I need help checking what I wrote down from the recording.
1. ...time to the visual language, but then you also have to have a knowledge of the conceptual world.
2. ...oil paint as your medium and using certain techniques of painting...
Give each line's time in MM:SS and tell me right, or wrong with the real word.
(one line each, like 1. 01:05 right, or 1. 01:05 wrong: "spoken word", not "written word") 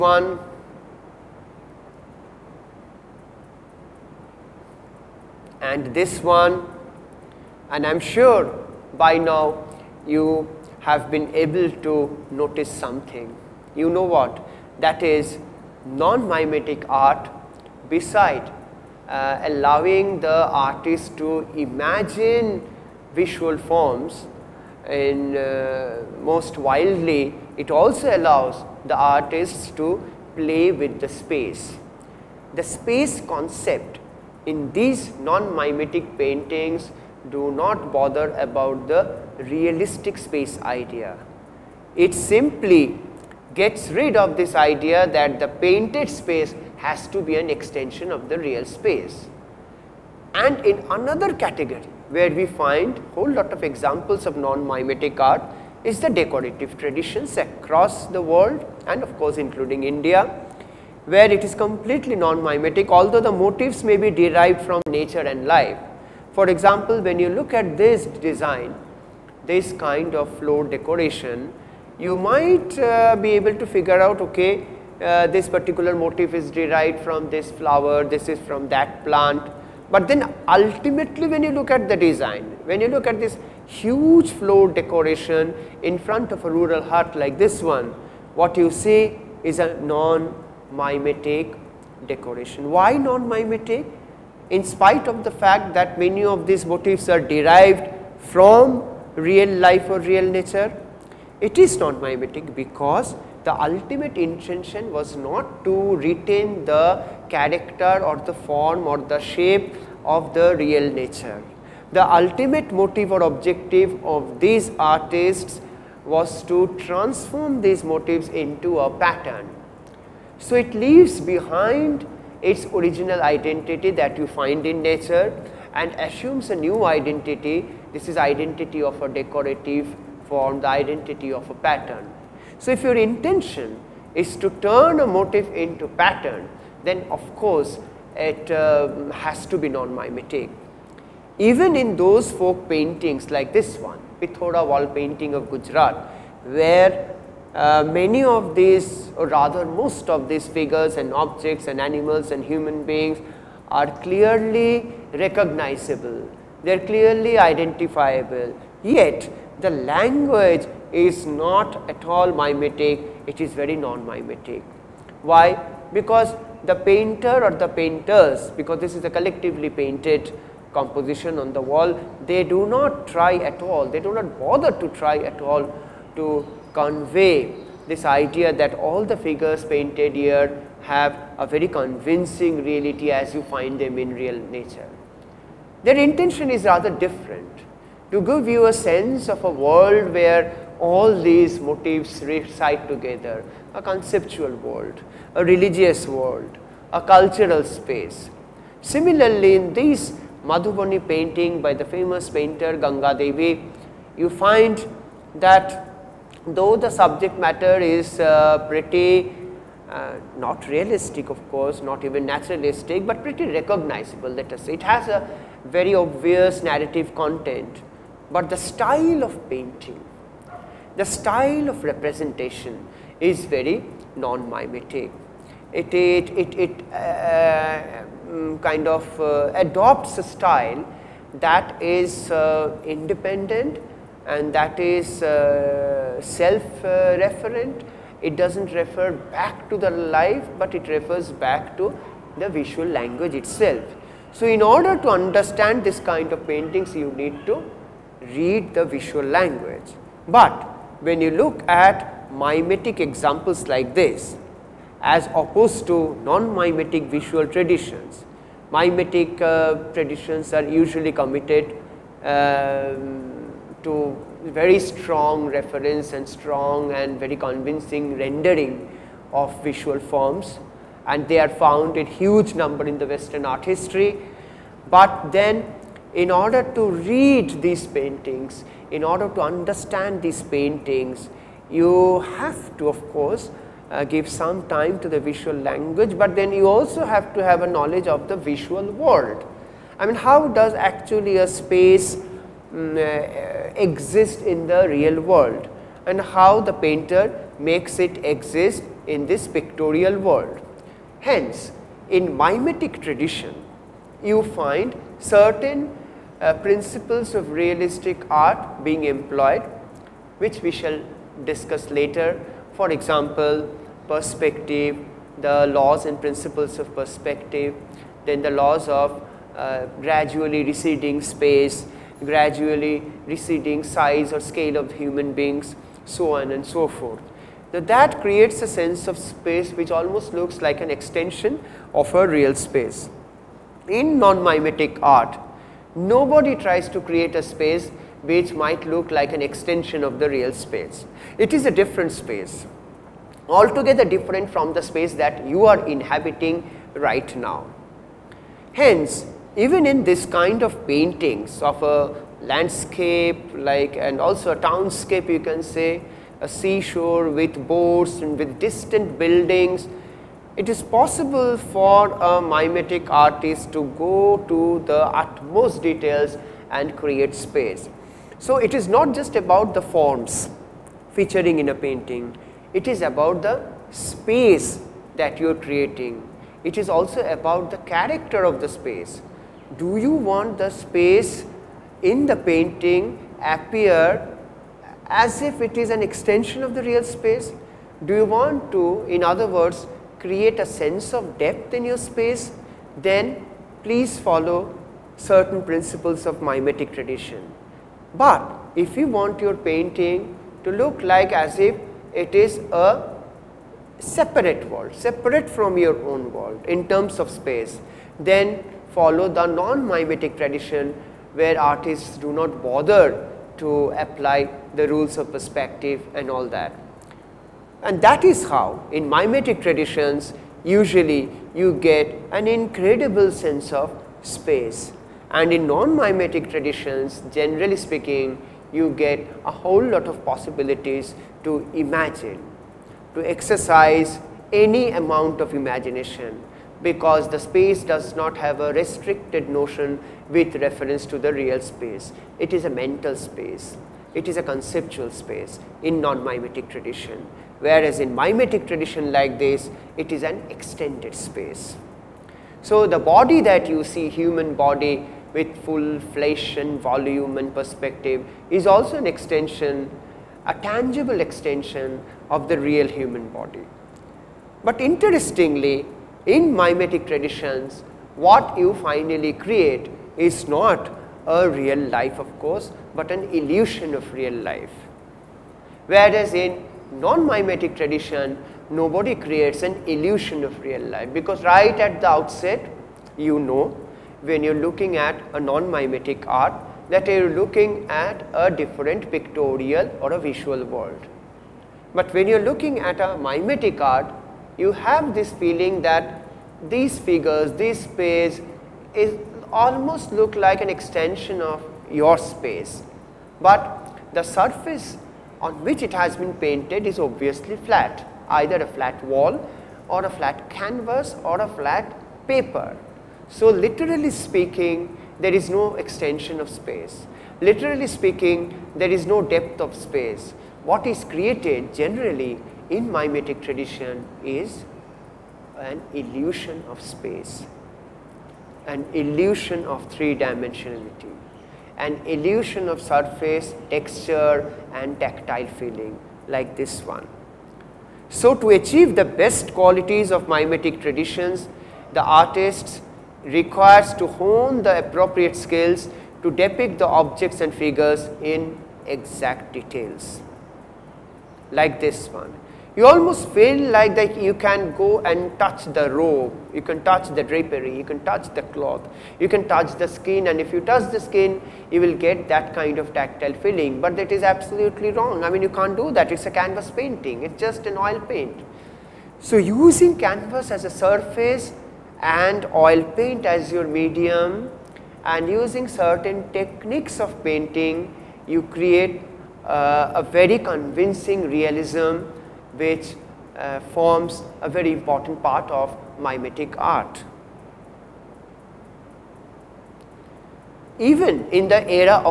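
1. 04:44 wrong: "visual", not "conceptual"
2. 09:32 right.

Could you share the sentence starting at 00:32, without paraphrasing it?
The space concept in these non-mimetic paintings do not bother about the realistic space idea.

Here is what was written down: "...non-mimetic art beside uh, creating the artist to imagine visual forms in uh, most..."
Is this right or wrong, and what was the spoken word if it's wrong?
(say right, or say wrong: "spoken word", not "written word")
wrong: "allowing", not "creating".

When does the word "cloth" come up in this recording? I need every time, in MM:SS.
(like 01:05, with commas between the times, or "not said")
09:18.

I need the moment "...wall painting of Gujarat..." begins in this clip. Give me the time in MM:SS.
02:24.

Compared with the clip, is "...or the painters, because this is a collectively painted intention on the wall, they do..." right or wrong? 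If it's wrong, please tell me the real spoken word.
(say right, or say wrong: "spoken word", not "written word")
wrong: "composition", not "intention".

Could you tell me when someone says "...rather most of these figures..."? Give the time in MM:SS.
02:29.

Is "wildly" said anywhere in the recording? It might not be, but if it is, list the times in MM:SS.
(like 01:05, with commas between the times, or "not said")
00:26.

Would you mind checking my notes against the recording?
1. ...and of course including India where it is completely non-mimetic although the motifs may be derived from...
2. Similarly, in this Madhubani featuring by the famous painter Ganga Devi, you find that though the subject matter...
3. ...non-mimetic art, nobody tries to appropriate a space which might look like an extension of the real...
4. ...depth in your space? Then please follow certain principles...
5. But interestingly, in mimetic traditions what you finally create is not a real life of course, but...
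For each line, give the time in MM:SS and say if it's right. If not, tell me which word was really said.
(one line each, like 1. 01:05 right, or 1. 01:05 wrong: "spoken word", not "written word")
1. 00:58 right
2. 03:18 wrong: "painting", not "featuring"
3. 05:34 wrong: "create", not "appropriate"
4. 06:31 right
5. 07:44 right.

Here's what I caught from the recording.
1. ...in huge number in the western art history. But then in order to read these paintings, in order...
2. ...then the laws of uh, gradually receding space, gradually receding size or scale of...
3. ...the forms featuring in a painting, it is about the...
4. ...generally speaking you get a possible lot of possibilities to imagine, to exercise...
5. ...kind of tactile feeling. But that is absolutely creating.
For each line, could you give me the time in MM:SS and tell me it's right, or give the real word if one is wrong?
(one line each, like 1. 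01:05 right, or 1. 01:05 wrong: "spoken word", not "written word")
1. 04:31 right
2. 05:18 right
3. 06:09 right
4. 07:07 wrong: "whole", not "possible"
5. 09:22 wrong: "wrong", not "creating".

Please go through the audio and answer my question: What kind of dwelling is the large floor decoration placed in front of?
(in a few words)
A rural hut.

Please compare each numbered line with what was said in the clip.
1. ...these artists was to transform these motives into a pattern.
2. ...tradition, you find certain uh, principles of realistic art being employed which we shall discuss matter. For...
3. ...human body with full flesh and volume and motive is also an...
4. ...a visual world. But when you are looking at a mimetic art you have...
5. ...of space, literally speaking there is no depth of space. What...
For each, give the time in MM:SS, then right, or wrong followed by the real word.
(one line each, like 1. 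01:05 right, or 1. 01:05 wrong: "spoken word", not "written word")
1. 01:54 right
2. 05:02 wrong: "later", not "matter"
3. 07:34 wrong: "perspective", not "motive"
4. 08:10 right
5. 08:36 right.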